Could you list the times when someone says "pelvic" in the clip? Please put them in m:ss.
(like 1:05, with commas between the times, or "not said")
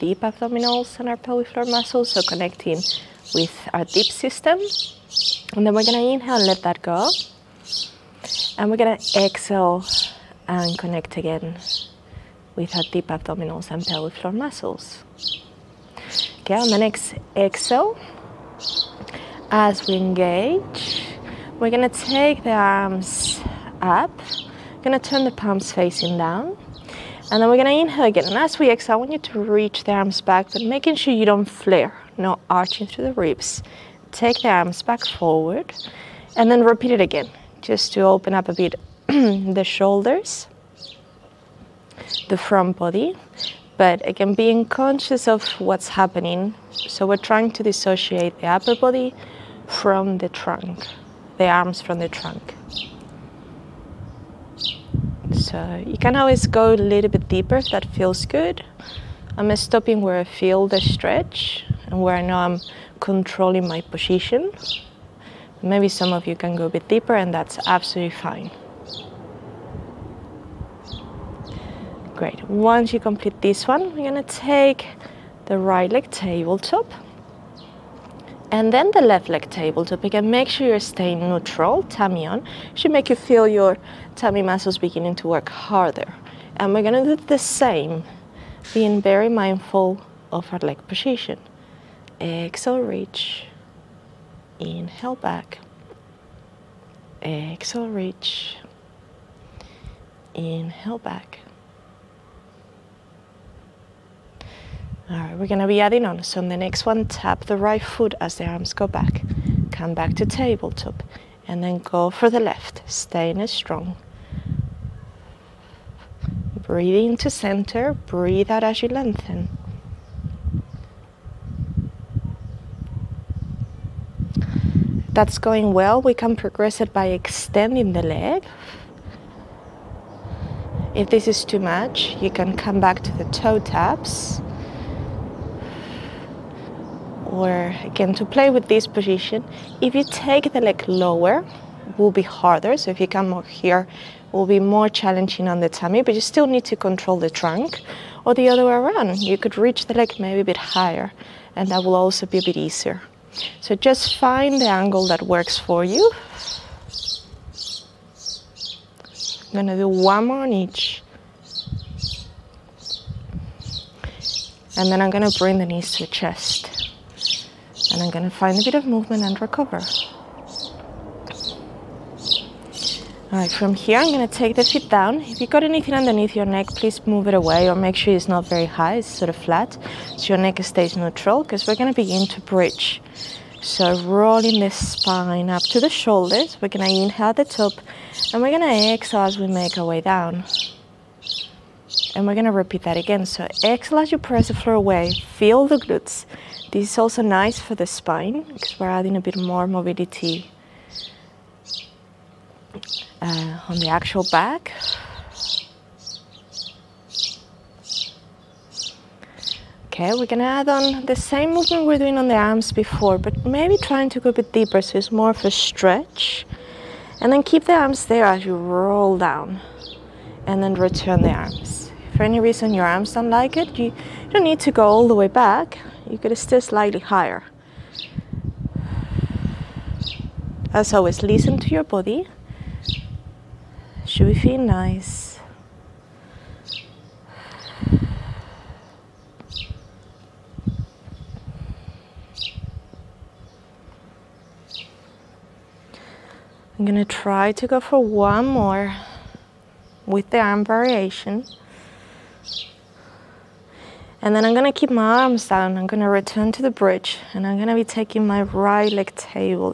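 0:01, 0:13.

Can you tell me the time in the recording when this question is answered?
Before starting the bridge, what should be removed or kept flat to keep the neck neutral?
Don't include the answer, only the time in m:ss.
2:55.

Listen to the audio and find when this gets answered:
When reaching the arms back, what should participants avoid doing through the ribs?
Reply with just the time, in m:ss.
0:32.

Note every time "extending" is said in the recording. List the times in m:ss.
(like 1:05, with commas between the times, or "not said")
2:07.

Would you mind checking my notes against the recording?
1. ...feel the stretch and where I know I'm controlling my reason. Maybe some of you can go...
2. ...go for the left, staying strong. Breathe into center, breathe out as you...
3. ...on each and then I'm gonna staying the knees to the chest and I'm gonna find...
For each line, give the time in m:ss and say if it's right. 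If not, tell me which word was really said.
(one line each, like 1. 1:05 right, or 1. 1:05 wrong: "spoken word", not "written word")
1. 1:00 wrong: "position", not "reason"
2. 1:51 right
3. 2:40 wrong: "bring", not "staying".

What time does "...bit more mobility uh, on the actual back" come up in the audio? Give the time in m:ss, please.
3:19.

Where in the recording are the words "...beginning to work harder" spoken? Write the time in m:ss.
1:24.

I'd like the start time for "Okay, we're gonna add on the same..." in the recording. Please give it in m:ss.
3:29.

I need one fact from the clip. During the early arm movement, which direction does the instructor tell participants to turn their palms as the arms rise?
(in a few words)
Facing down.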